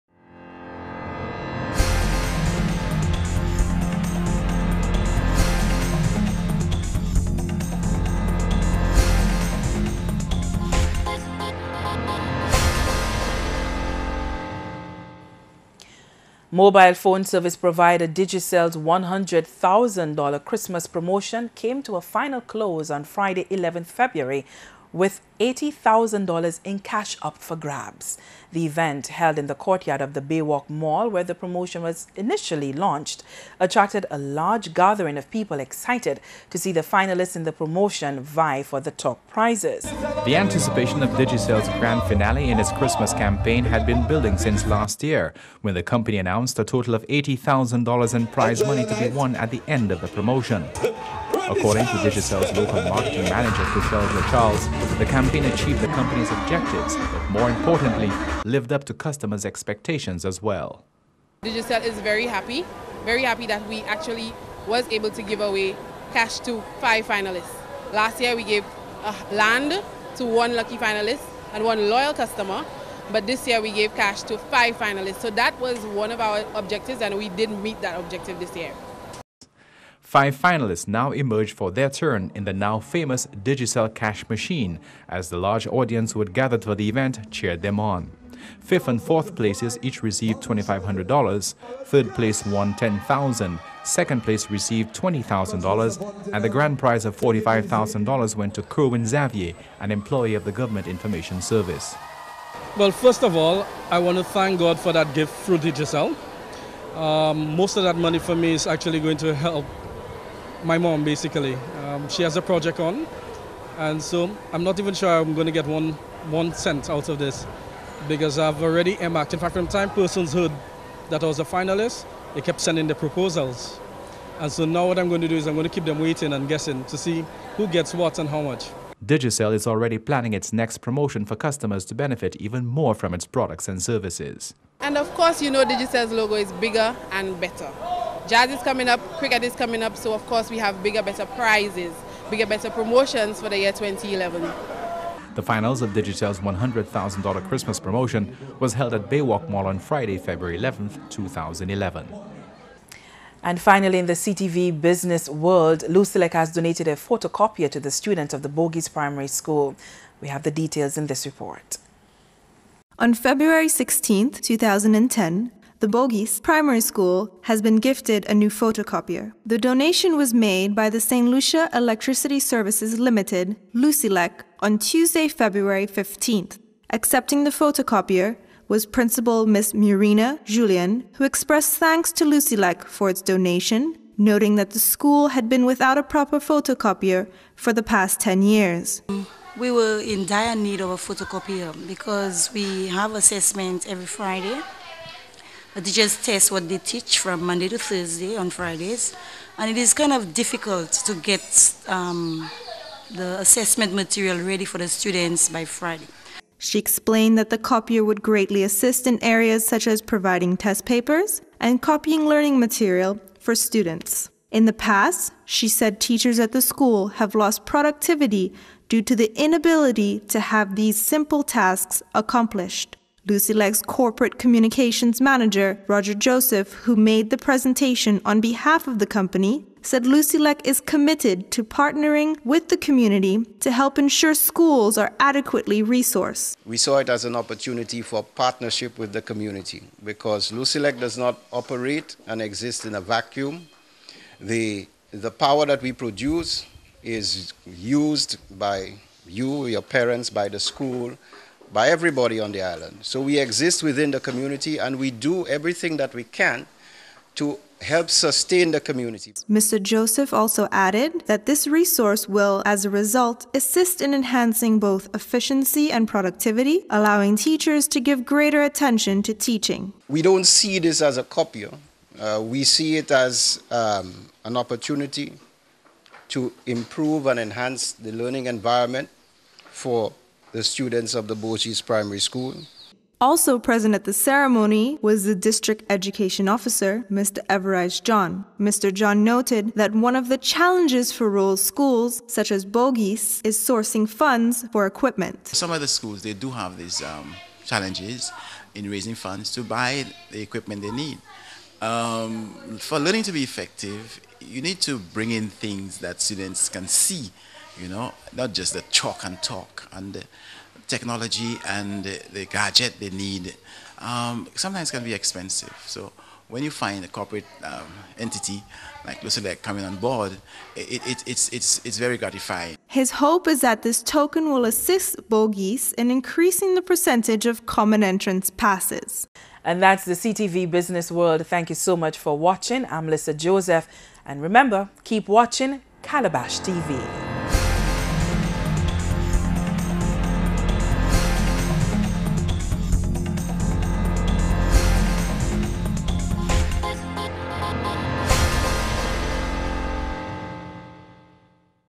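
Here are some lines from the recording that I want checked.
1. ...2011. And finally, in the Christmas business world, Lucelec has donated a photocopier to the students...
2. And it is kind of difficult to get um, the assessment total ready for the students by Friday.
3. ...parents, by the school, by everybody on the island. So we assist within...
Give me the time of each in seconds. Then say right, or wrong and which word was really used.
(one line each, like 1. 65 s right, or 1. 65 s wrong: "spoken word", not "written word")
1. 151 s wrong: "CTV", not "Christmas"
2. 199 s wrong: "material", not "total"
3. 249 s wrong: "exist", not "assist".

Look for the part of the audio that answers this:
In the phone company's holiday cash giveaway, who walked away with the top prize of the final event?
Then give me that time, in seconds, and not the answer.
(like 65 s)
98 s.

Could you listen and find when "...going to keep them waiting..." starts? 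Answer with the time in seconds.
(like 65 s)
125 s.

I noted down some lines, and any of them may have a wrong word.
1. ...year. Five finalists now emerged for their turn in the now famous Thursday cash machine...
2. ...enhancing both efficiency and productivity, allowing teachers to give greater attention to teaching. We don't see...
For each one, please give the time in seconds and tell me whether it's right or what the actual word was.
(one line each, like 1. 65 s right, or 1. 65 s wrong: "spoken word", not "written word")
1. 78 s wrong: "Digicel", not "Thursday"
2. 264 s right.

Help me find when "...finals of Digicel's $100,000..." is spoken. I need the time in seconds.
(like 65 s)
145 s.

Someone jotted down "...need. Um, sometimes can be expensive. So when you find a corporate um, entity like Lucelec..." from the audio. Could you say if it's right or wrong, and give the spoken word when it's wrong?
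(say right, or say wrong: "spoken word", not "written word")
right.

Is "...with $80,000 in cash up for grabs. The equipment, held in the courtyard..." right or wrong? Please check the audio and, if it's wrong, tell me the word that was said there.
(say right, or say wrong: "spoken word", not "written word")
wrong: "event", not "equipment".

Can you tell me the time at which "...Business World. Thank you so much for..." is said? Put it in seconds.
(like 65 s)
330 s.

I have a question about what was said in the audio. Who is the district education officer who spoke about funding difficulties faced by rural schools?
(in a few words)
Everise John.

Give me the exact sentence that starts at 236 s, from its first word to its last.
We saw it as an opportunity for partnership with the community because Lucy does not operate and exist in a vacuum.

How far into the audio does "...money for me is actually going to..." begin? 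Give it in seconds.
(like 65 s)
107 s.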